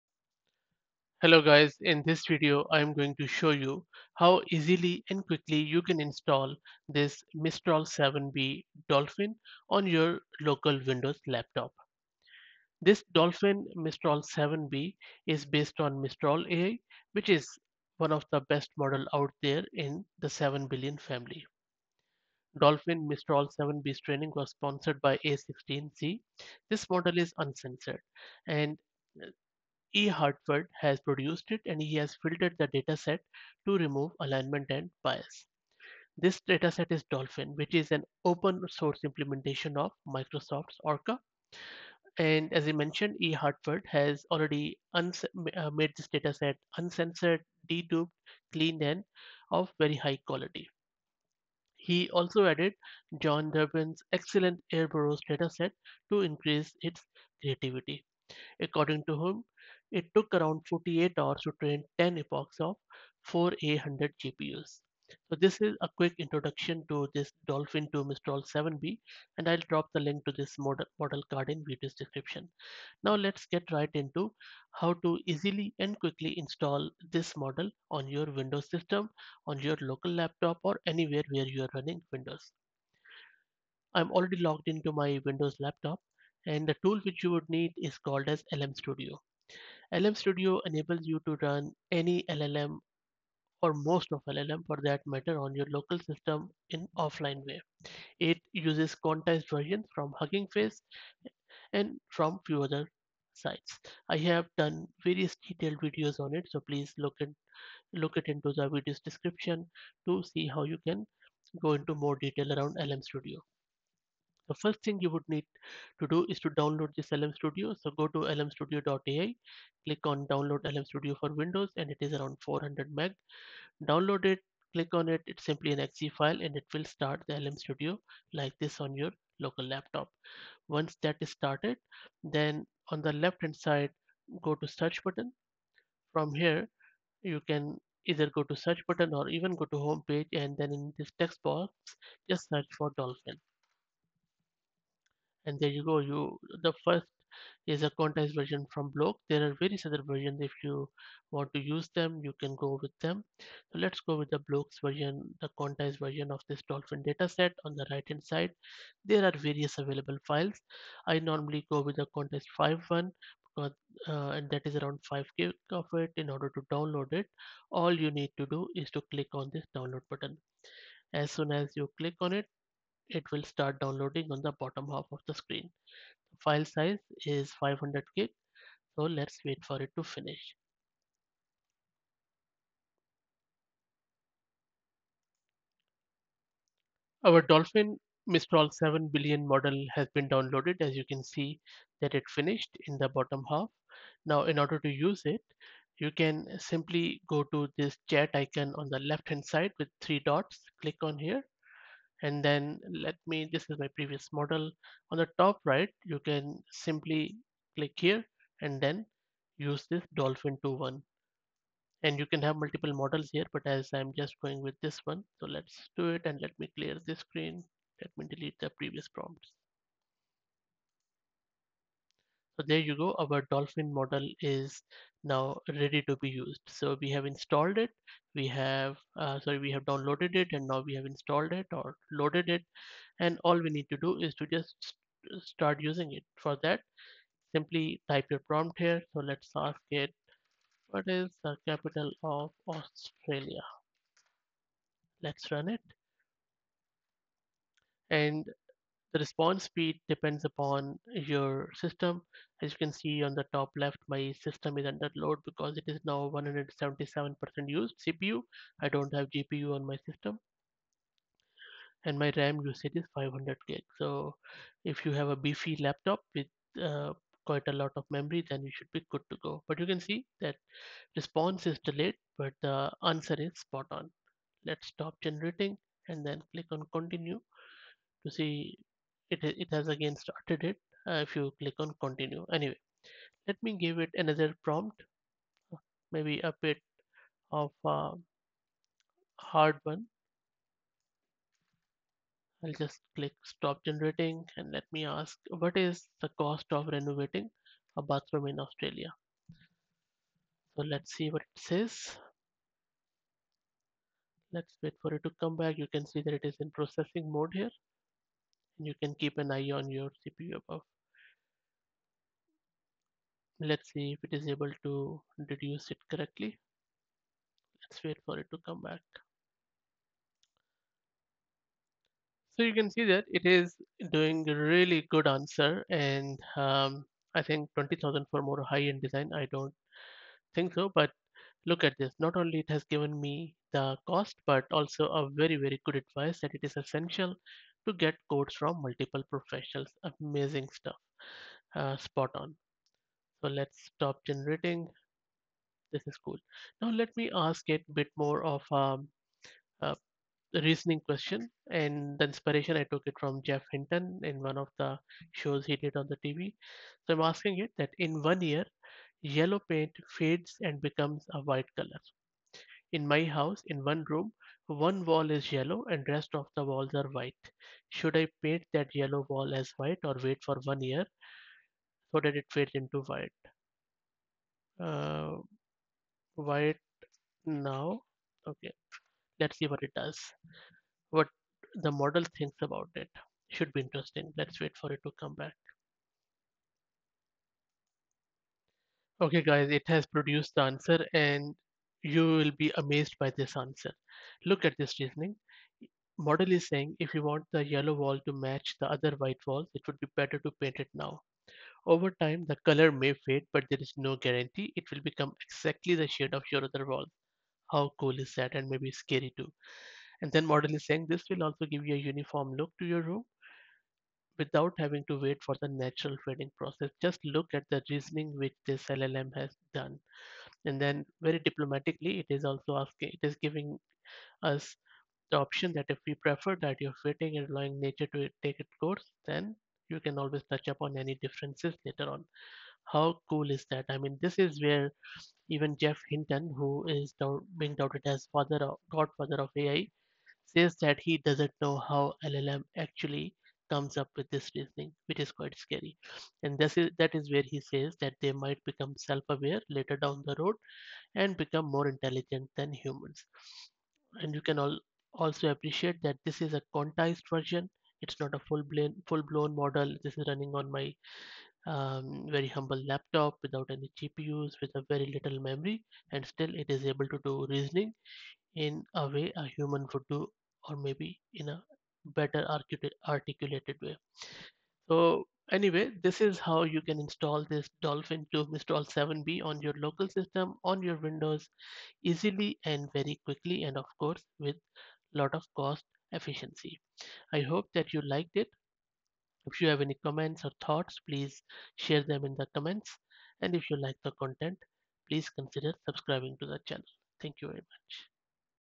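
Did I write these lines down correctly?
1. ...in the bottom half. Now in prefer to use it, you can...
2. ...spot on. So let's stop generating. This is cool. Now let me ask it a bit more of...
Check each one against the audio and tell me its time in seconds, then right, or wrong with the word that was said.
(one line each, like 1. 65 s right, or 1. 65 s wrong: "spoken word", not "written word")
1. 192 s wrong: "order", not "prefer"
2. 341 s right.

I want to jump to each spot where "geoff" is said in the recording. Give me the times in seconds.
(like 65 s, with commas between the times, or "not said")
353 s, 435 s.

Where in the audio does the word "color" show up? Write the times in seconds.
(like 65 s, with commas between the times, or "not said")
361 s, 402 s.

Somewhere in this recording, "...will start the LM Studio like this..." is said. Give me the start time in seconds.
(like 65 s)
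126 s.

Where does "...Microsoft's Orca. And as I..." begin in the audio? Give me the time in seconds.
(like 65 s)
40 s.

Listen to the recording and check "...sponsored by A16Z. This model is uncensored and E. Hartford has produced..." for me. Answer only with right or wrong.
right.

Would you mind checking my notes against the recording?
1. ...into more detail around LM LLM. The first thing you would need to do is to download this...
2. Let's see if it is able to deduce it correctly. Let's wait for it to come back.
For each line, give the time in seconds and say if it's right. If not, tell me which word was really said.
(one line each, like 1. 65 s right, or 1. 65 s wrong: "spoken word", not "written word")
1. 111 s wrong: "Studio", not "LLM"
2. 313 s right.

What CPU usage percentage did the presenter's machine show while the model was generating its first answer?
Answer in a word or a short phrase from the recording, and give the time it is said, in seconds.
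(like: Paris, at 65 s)
177%, at 256 s.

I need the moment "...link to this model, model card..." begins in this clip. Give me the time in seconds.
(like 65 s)
69 s.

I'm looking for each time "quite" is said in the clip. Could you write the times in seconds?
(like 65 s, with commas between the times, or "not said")
267 s, 445 s.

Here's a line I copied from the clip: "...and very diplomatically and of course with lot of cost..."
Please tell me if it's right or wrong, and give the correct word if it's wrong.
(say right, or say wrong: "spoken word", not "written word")
wrong: "quickly", not "diplomatically".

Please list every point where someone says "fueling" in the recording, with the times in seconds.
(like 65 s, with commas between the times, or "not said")
not said.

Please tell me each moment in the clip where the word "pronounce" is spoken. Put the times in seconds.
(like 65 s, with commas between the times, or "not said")
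not said.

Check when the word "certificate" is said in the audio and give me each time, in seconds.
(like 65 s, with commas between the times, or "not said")
not said.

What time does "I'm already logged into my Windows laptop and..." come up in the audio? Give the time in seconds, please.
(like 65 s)
83 s.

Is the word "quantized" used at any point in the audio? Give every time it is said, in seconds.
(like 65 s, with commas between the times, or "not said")
98 s, 147 s, 155 s, 162 s, 456 s.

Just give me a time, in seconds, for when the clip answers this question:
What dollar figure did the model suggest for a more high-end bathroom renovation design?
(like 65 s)
327 s.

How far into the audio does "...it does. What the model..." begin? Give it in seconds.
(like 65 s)
379 s.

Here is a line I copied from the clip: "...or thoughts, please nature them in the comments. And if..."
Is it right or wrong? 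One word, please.
wrong.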